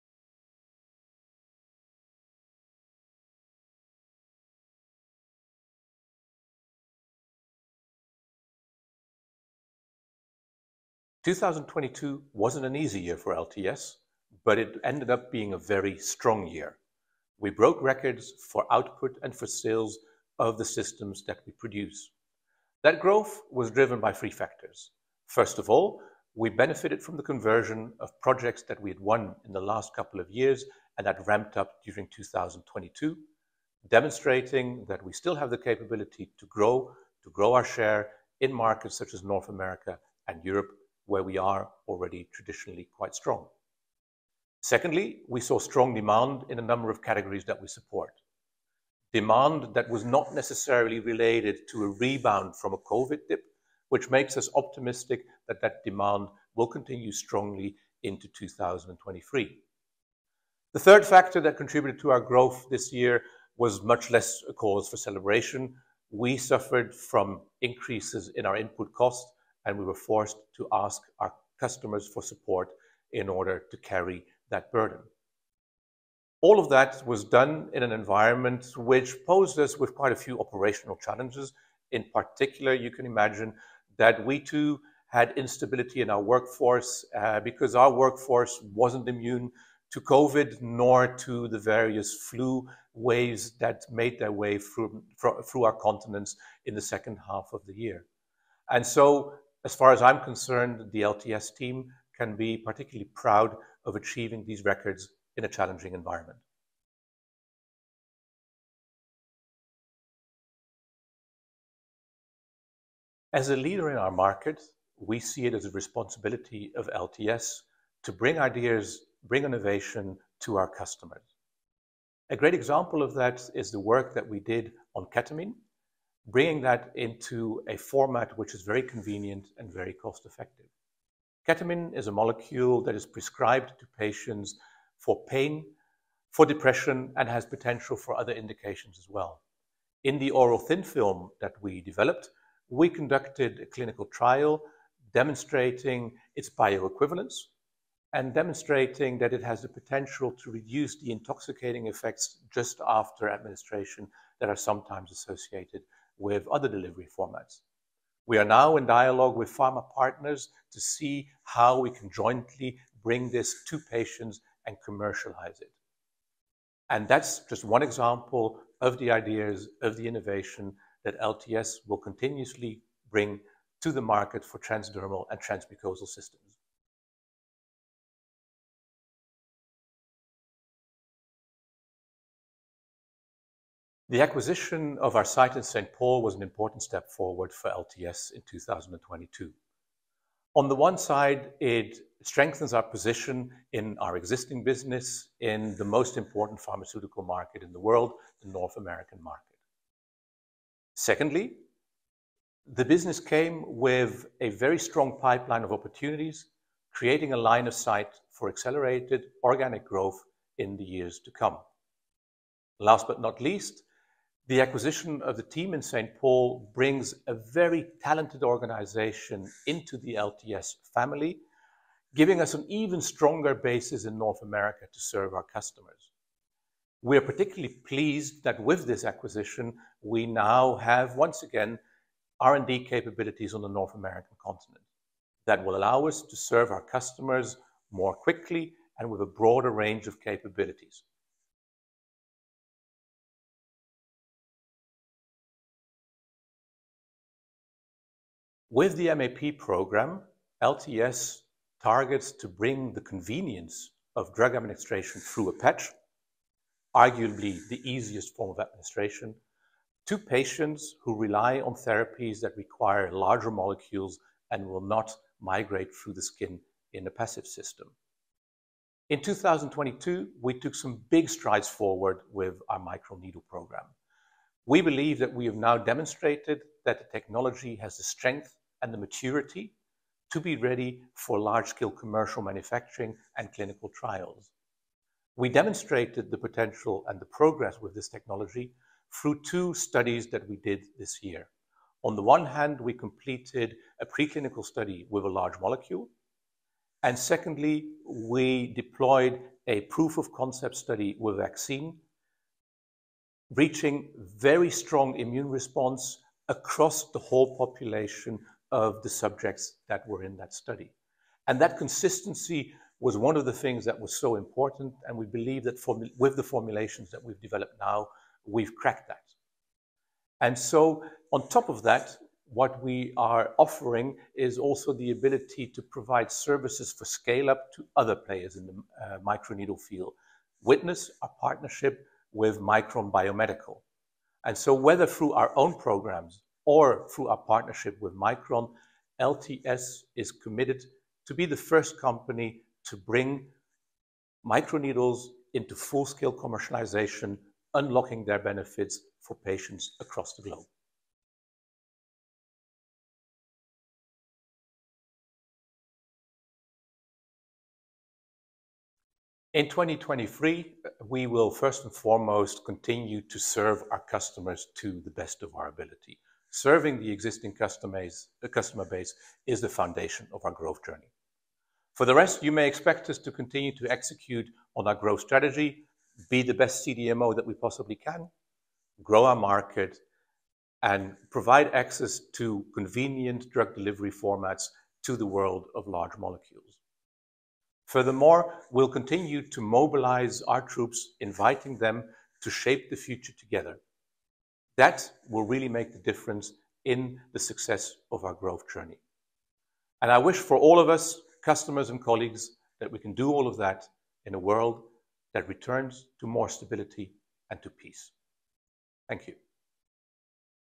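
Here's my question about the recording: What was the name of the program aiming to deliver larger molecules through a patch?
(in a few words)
MAP program.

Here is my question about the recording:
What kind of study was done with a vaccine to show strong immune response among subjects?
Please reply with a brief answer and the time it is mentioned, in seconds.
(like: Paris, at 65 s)
proof of concept study, at 299 s.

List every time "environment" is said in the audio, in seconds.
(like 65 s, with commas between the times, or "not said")
77 s, 105 s.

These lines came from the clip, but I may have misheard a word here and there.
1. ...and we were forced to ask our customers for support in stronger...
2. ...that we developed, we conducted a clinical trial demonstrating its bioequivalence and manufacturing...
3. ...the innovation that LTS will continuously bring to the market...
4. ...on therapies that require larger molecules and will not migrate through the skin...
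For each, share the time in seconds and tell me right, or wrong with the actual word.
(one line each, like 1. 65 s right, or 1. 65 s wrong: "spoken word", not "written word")
1. 69 s wrong: "order", not "stronger"
2. 141 s wrong: "demonstrating", not "manufacturing"
3. 169 s right
4. 261 s right.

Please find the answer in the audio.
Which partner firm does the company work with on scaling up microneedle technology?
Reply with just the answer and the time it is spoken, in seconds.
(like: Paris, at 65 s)
Micron Biomedical, at 332 s.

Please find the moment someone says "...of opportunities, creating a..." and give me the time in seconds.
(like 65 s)
205 s.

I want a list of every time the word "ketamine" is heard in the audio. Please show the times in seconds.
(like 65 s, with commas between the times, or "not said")
125 s, 131 s.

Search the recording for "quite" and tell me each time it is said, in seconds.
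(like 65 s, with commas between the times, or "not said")
42 s, 79 s.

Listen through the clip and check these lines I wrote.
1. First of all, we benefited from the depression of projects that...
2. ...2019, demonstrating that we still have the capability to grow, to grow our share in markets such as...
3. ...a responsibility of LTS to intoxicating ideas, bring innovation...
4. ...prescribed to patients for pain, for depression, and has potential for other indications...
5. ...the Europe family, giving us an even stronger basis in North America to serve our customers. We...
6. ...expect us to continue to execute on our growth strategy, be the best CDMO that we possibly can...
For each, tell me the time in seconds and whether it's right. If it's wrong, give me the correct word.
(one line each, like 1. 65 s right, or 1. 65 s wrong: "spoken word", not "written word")
1. 25 s wrong: "conversion", not "depression"
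2. 32 s wrong: "2022", not "2019"
3. 115 s wrong: "bring", not "intoxicating"
4. 133 s right
5. 219 s wrong: "LTS", not "Europe"
6. 372 s right.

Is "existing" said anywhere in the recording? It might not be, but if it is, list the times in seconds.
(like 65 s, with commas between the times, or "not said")
194 s, 367 s.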